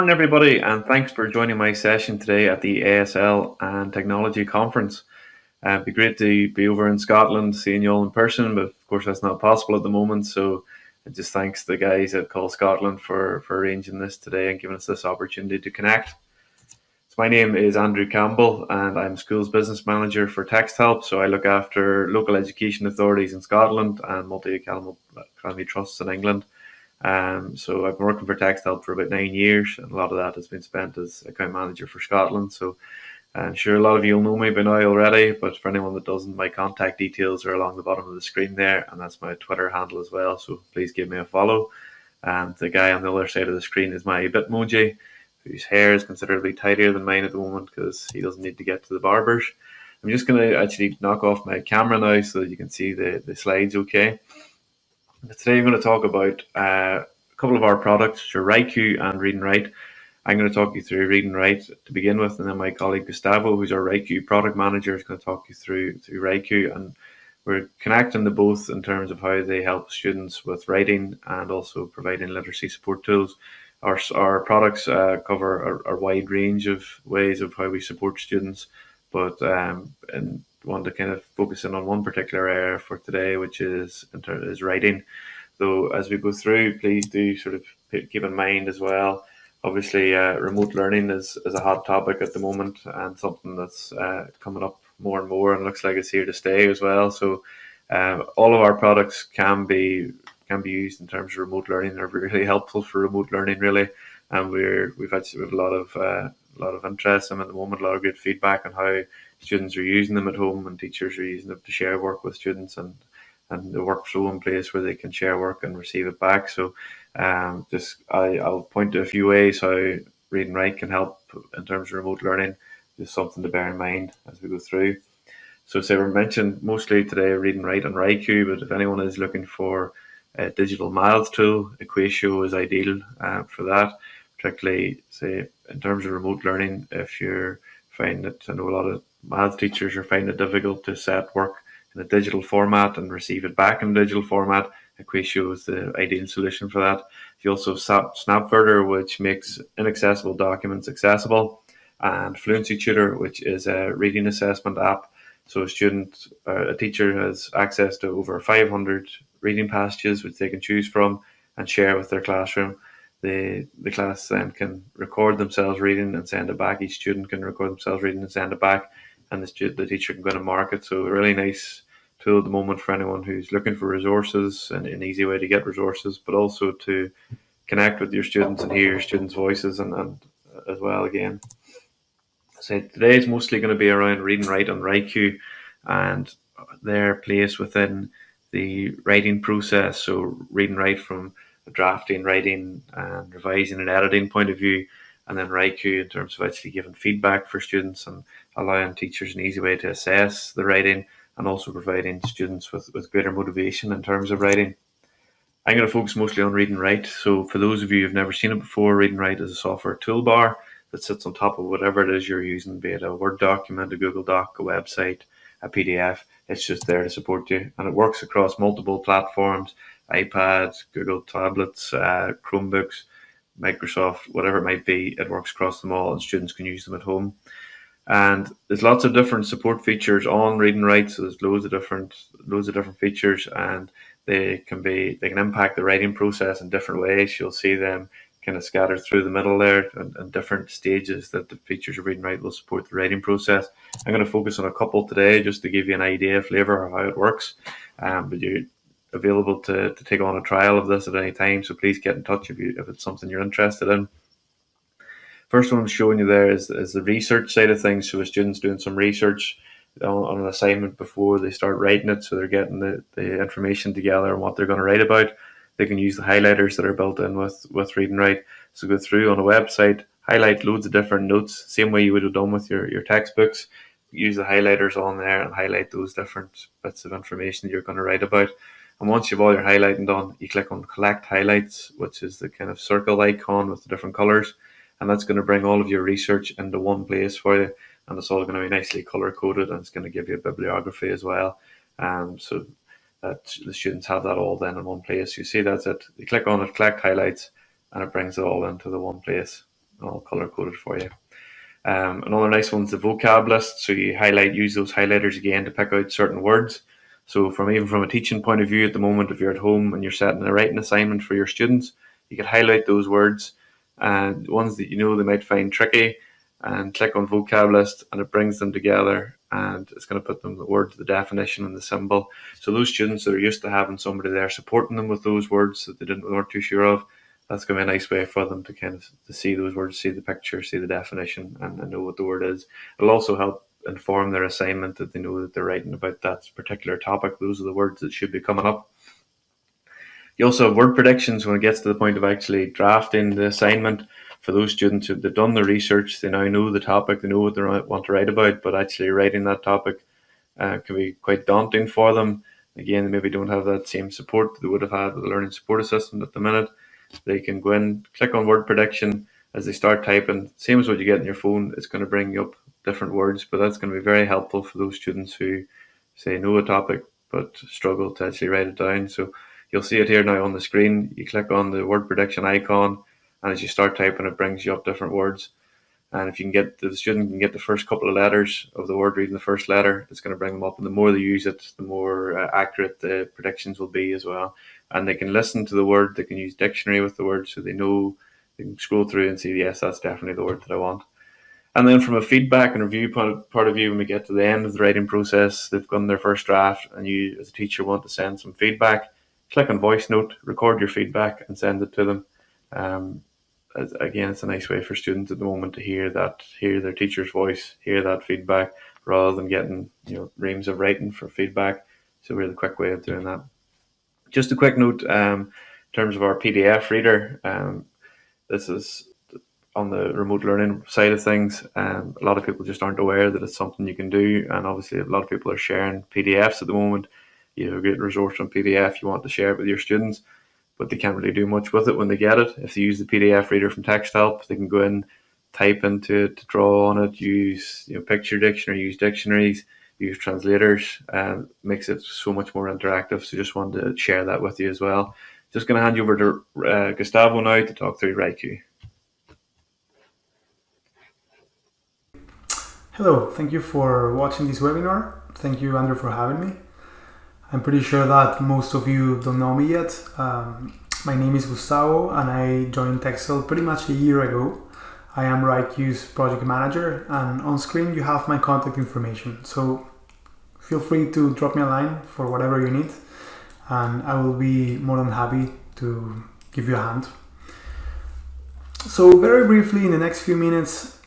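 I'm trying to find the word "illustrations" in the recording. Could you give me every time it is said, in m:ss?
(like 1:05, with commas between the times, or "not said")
not said.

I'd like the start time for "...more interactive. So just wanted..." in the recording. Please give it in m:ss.
7:22.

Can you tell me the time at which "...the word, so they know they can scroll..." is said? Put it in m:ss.
6:27.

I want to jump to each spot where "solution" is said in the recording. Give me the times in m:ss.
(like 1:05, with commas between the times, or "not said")
2:26.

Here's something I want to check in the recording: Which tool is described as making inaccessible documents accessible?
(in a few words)
Snapverter.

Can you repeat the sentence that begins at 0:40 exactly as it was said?
So please give me a follow.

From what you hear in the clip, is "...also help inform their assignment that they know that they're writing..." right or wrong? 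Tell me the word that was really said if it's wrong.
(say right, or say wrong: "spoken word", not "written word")
right.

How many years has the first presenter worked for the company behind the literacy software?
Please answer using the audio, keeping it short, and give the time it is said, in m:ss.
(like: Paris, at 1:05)
9, at 0:29.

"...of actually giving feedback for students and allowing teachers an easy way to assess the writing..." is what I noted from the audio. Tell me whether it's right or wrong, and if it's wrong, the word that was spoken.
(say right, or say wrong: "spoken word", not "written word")
right.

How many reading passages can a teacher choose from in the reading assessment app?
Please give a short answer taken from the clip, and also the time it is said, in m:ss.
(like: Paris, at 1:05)
over 500, at 2:38.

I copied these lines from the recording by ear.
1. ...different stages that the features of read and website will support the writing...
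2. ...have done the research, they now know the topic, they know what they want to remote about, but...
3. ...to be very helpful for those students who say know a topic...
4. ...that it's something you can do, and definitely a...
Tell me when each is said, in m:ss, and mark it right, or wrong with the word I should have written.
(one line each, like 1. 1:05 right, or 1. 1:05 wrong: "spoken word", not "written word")
1. 4:00 wrong: "write", not "website"
2. 5:45 wrong: "write", not "remote"
3. 6:03 right
4. 7:03 wrong: "obviously", not "definitely".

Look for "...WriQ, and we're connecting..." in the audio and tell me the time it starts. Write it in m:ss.
1:06.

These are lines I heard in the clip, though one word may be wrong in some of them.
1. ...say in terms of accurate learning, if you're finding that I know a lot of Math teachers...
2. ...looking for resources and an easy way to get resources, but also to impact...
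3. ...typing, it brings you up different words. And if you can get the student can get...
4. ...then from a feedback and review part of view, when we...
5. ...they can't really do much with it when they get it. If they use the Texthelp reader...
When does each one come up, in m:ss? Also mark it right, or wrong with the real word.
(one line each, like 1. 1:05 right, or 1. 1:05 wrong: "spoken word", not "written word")
1. 2:15 wrong: "remote", not "accurate"
2. 2:53 wrong: "connect", not "impact"
3. 6:13 right
4. 6:31 right
5. 7:10 wrong: "PDF", not "Texthelp".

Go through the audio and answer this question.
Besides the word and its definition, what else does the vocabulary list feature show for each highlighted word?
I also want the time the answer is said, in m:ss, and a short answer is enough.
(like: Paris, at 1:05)
the symbol, at 5:21.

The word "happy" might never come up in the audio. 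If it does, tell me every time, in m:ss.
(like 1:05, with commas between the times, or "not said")
7:55.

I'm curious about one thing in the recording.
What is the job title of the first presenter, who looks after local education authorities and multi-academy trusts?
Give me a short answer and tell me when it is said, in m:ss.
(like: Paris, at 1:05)
Schools Business Manager, at 0:19.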